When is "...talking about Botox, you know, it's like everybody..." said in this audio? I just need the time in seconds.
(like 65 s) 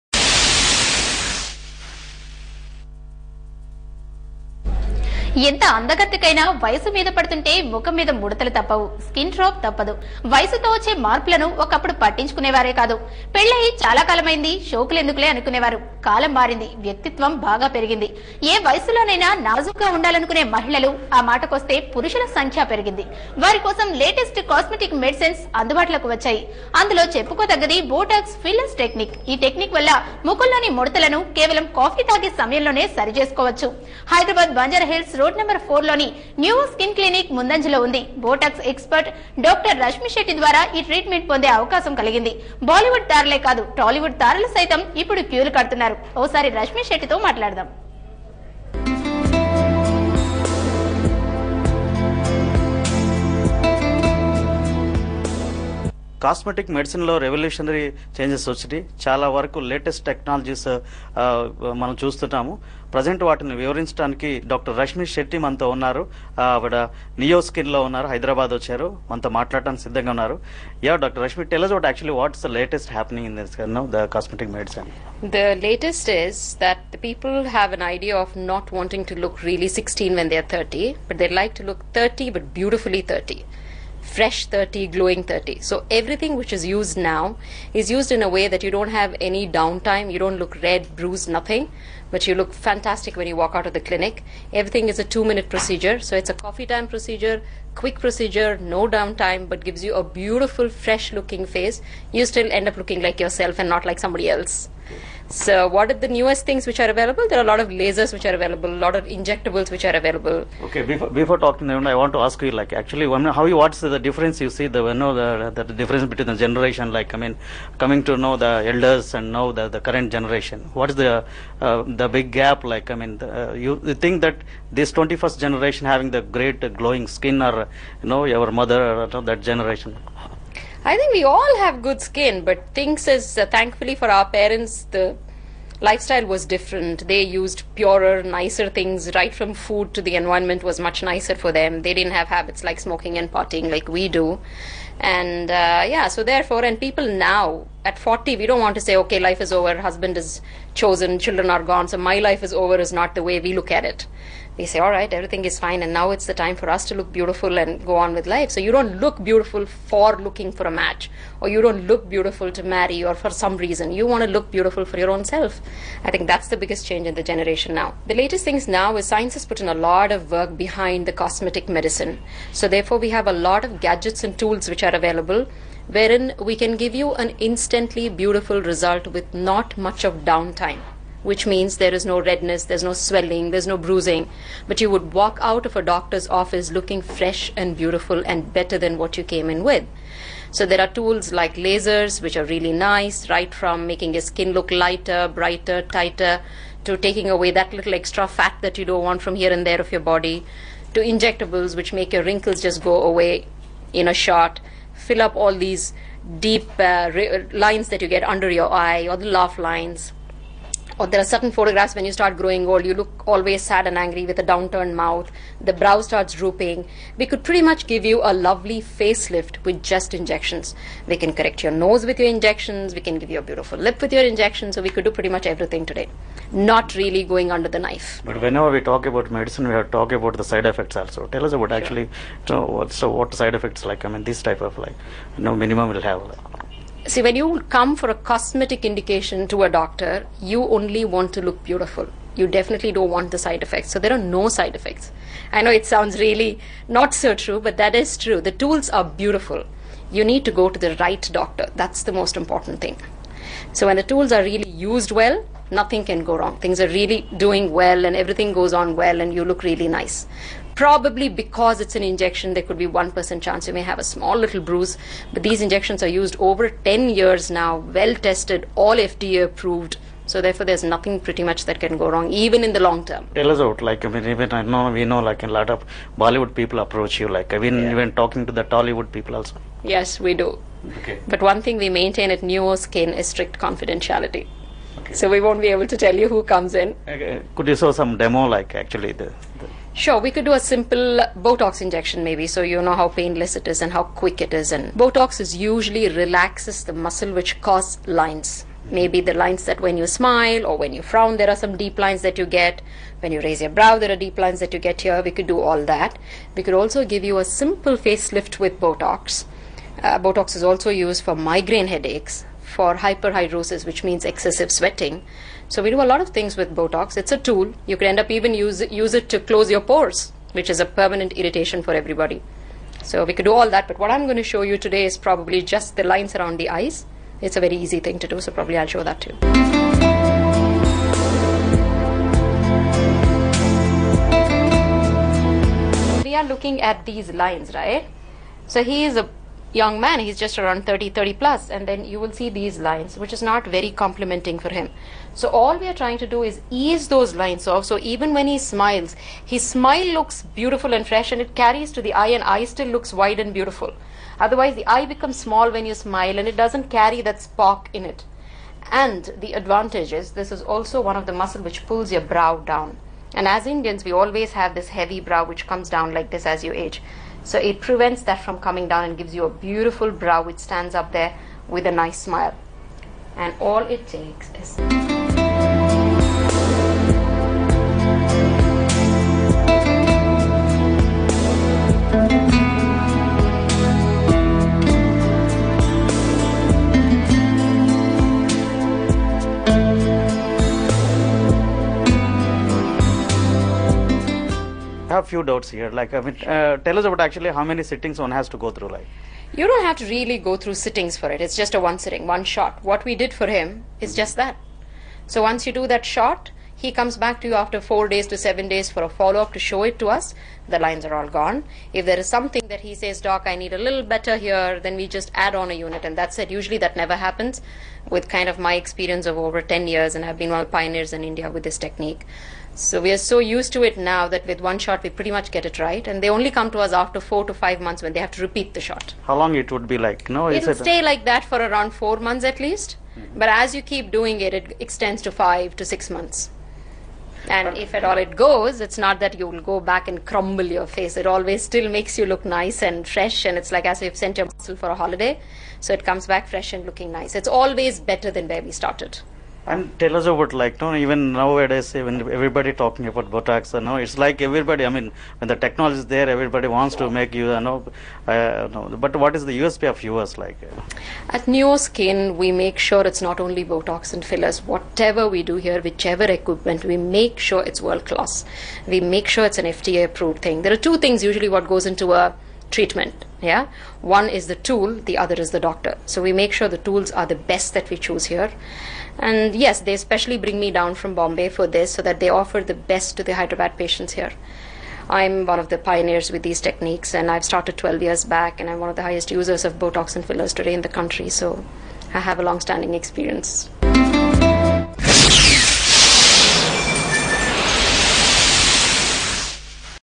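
452 s.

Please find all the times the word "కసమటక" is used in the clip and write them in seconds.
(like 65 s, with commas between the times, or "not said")
24 s, 56 s, 74 s.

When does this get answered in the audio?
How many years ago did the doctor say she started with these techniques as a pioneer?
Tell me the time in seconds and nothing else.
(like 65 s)
487 s.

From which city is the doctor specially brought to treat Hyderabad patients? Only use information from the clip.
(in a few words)
Bombay.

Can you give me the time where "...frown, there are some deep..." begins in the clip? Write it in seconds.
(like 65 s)
301 s.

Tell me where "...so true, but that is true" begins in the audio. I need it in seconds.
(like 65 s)
247 s.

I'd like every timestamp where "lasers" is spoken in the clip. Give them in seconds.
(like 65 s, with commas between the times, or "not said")
107 s, 191 s.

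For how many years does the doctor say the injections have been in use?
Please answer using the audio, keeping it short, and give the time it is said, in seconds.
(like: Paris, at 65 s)
10 years, at 266 s.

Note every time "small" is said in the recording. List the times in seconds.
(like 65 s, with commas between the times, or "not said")
264 s, 355 s.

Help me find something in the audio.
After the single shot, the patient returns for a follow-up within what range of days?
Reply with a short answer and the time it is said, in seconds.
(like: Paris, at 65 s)
4 to 7 days, at 407 s.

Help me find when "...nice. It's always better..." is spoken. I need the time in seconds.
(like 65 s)
447 s.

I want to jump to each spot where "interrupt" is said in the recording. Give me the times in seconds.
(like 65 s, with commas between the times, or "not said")
not said.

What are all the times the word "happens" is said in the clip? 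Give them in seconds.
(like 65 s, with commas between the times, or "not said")
417 s.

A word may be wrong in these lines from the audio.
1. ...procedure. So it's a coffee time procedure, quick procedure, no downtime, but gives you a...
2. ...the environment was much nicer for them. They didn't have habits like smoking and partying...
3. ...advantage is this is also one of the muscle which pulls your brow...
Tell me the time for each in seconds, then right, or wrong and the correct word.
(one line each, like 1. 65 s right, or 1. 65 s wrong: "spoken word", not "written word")
1. 95 s right
2. 140 s right
3. 359 s right.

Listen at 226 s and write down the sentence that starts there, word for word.
Not really going under the knife.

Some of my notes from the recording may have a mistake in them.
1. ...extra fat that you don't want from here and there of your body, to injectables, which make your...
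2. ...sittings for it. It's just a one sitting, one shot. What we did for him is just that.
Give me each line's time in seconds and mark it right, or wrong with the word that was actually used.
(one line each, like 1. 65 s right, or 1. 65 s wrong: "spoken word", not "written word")
1. 197 s right
2. 400 s right.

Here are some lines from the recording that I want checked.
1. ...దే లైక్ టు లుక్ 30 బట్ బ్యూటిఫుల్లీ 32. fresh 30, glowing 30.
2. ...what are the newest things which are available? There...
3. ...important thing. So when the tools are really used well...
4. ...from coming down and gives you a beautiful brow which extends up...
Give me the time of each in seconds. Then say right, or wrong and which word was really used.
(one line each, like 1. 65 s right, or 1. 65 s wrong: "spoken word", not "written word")
1. 81 s wrong: "30", not "32"
2. 105 s right
3. 252 s right
4. 368 s wrong: "stands", not "extends".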